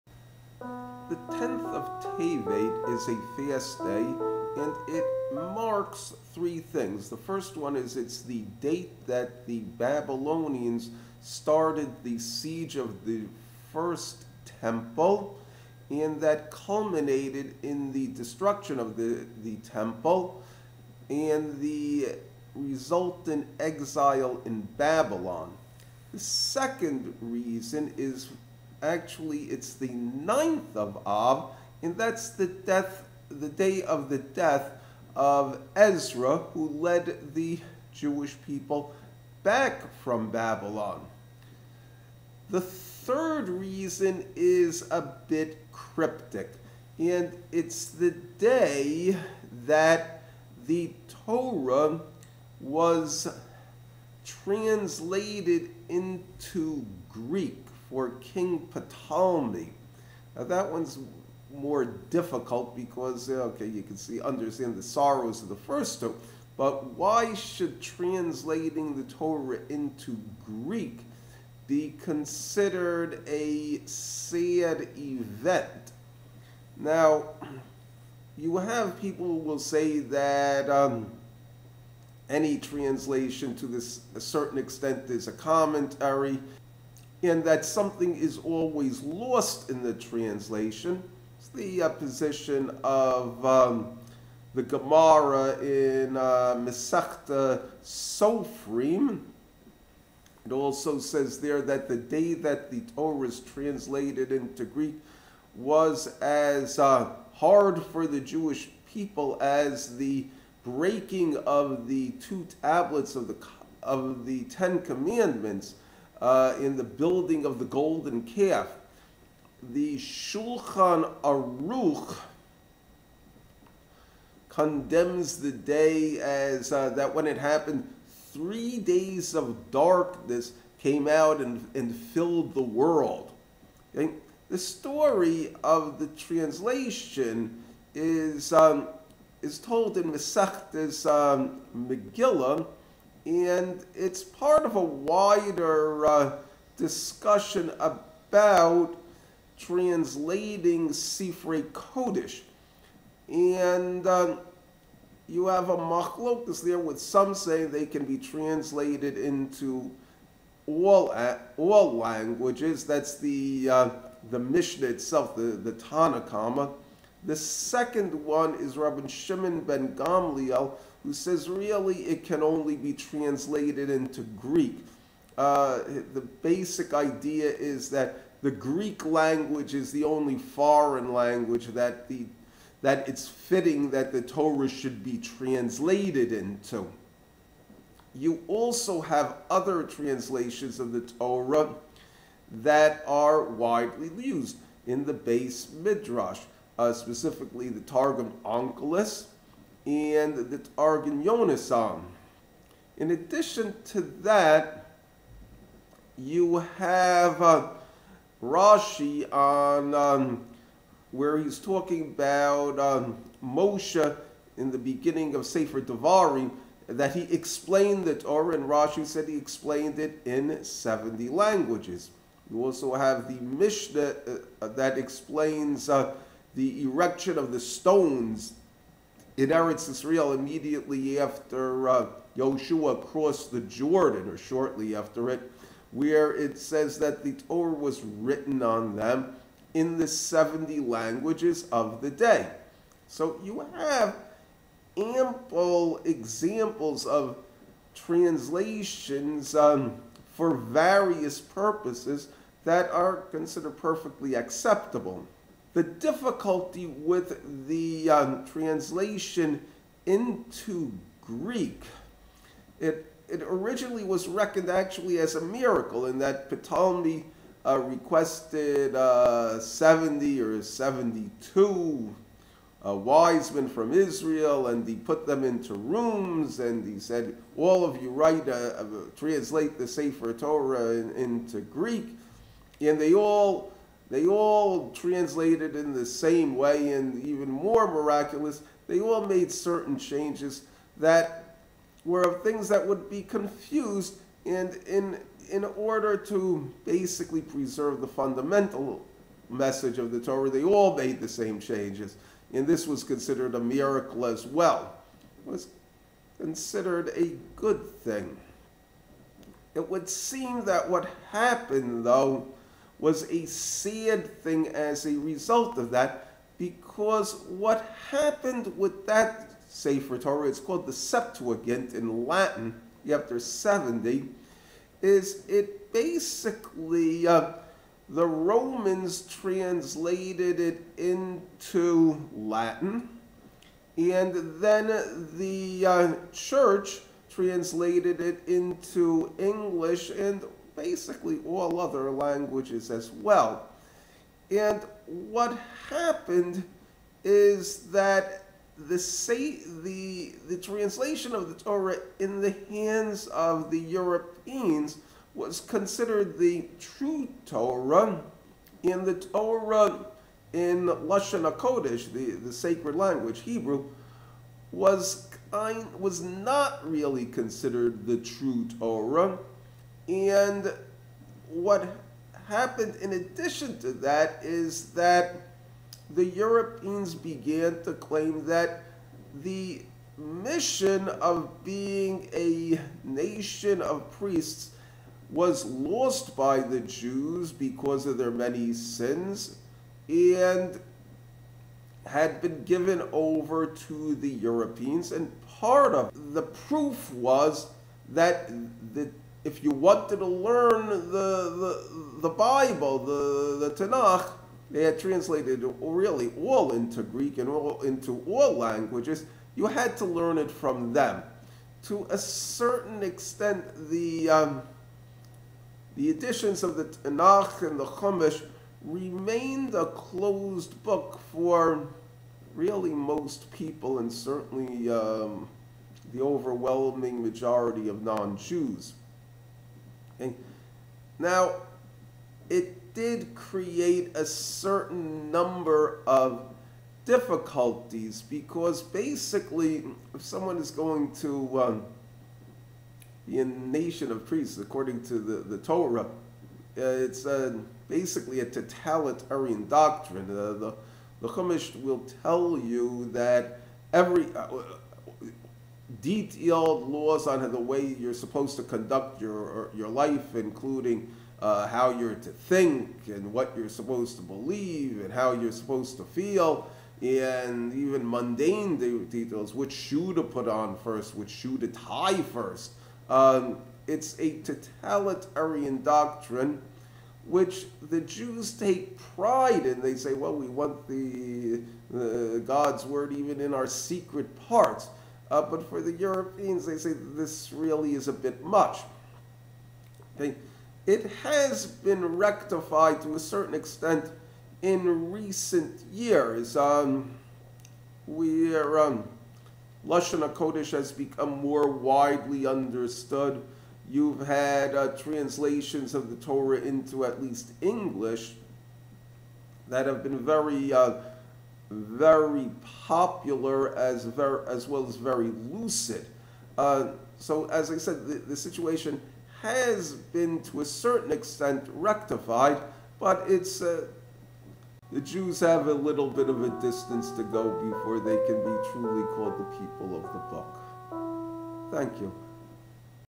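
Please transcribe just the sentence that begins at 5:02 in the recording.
And this was considered a miracle as well.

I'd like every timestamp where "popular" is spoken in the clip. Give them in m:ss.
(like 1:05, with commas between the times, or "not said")
8:32.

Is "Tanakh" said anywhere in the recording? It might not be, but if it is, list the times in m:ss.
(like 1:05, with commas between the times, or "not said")
6:43, 6:56.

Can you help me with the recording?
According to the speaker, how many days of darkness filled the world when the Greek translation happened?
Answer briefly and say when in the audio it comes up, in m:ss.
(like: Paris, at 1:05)
3, at 2:08.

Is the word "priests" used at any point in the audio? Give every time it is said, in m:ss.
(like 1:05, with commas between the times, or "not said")
6:24, 7:24.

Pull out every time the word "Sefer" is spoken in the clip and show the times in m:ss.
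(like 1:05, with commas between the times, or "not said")
3:35, 4:39, 5:19.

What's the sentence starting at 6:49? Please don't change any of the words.
You had to learn it from them.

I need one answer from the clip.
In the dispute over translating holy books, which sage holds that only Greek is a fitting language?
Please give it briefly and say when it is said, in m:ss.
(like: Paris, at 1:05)
Rabbi Shimon ben Gamliel, at 2:48.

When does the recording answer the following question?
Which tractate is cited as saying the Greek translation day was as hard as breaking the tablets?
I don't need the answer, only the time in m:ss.
1:37.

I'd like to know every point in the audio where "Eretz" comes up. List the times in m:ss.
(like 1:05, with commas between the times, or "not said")
3:49.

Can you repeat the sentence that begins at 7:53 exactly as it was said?
Um, it's a totalitarian doctrine which the Jews take pride in.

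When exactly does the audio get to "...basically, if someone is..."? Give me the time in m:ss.
7:18.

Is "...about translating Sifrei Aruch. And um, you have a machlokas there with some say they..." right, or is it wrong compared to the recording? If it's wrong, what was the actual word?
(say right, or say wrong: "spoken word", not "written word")
wrong: "Kodesh", not "Aruch".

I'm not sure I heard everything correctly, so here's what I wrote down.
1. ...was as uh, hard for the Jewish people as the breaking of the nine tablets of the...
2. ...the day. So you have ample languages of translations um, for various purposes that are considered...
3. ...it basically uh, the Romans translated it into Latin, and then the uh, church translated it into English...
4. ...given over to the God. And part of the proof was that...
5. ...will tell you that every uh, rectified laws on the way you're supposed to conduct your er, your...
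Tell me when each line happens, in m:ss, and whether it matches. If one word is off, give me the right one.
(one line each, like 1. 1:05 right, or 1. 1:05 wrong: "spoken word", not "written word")
1. 1:45 wrong: "two", not "nine"
2. 4:02 wrong: "examples", not "languages"
3. 5:25 right
4. 6:32 wrong: "Europeans", not "God"
5. 7:31 wrong: "detailed", not "rectified".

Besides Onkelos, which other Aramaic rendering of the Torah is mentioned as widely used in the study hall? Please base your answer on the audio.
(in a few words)
Targum Yonasan.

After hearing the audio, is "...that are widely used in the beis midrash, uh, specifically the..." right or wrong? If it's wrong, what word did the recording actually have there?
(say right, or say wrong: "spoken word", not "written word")
right.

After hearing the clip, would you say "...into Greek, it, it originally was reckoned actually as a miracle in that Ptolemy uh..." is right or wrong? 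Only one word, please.
right.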